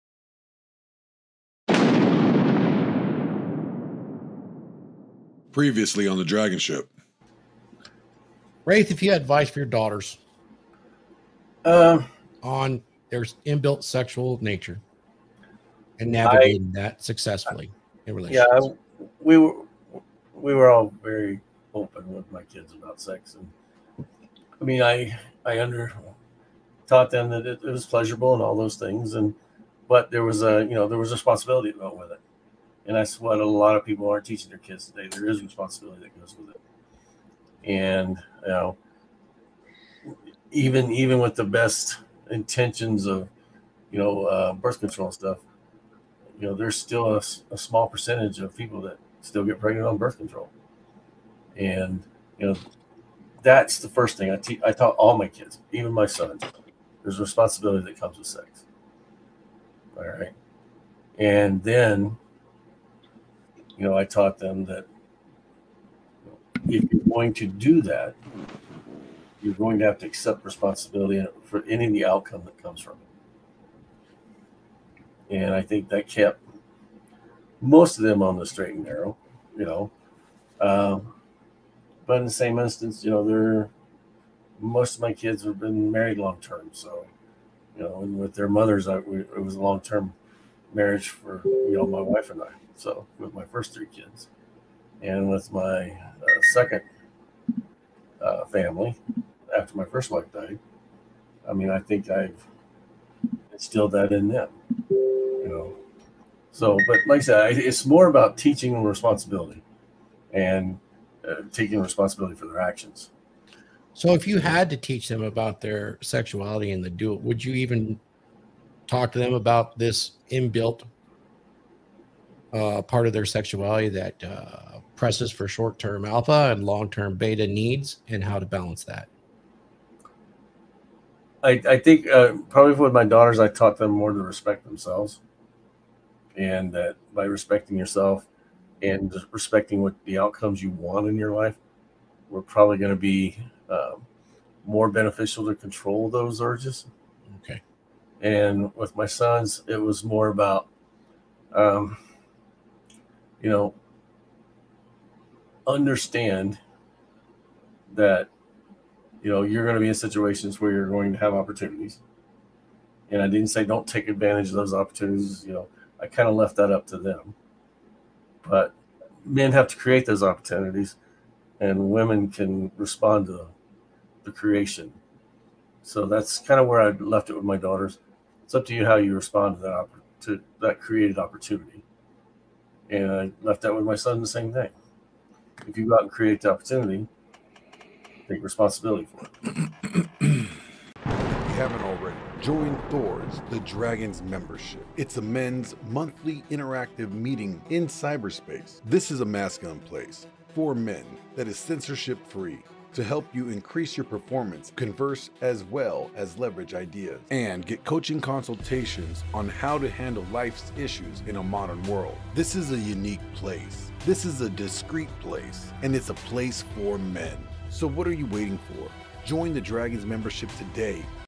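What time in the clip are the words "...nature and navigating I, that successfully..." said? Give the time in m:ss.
0:14.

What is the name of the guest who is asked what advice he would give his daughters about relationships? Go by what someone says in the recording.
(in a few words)
Raith.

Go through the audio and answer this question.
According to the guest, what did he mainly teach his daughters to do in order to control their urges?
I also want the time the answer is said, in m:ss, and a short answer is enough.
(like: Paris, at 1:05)
Respect themselves, at 2:14.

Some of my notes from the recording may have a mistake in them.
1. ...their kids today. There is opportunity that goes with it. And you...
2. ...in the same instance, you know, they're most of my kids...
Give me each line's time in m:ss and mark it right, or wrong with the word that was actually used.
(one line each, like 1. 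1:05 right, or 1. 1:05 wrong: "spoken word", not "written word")
1. 0:34 wrong: "responsibility", not "opportunity"
2. 1:22 right.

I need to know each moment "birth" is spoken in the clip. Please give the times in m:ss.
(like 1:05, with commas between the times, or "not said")
0:44, 0:49.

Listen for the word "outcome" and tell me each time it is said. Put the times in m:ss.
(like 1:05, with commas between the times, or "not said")
1:12, 2:20.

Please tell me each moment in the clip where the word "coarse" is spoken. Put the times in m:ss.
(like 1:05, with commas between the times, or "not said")
not said.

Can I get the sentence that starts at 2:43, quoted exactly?
And I didn't say don't take advantage of those opportunities.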